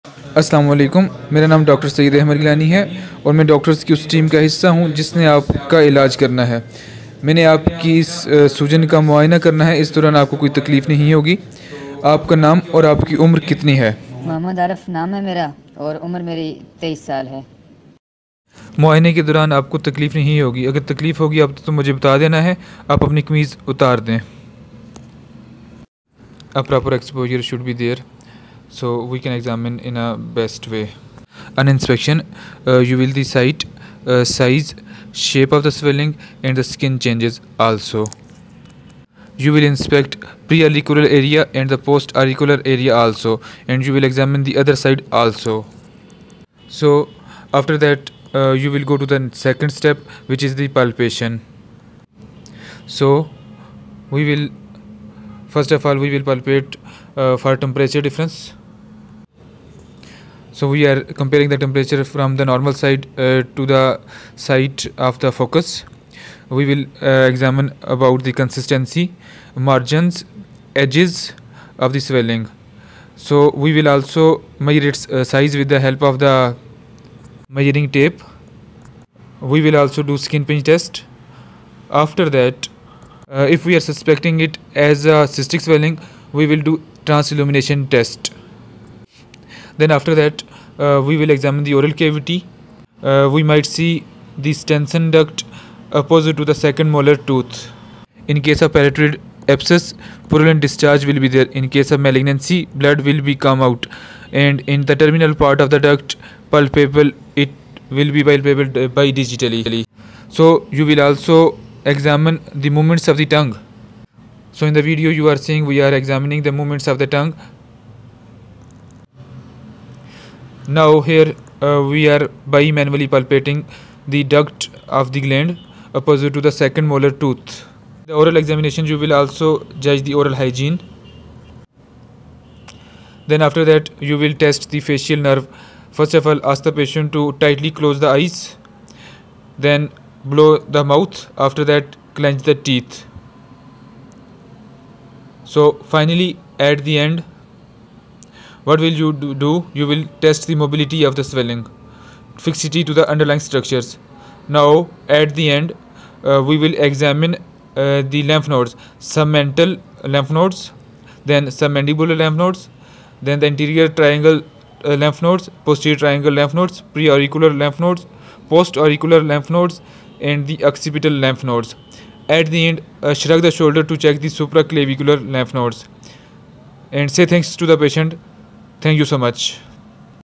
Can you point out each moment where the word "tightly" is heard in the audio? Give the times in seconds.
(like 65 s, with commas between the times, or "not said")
137 s.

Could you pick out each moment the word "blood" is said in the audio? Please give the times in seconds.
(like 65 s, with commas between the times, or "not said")
102 s.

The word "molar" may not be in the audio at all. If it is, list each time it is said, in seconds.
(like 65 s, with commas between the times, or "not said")
96 s, 126 s.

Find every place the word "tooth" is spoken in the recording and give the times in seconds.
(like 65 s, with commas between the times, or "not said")
97 s, 127 s.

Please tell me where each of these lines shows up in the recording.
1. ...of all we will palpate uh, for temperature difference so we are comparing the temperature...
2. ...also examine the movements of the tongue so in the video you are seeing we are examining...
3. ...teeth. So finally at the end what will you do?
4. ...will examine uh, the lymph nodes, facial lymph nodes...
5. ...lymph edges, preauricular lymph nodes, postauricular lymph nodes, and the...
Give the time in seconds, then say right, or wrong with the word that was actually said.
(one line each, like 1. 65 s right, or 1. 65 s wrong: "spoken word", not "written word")
1. 55 s right
2. 111 s right
3. 142 s right
4. 156 s wrong: "submental", not "facial"
5. 166 s wrong: "nodes", not "edges".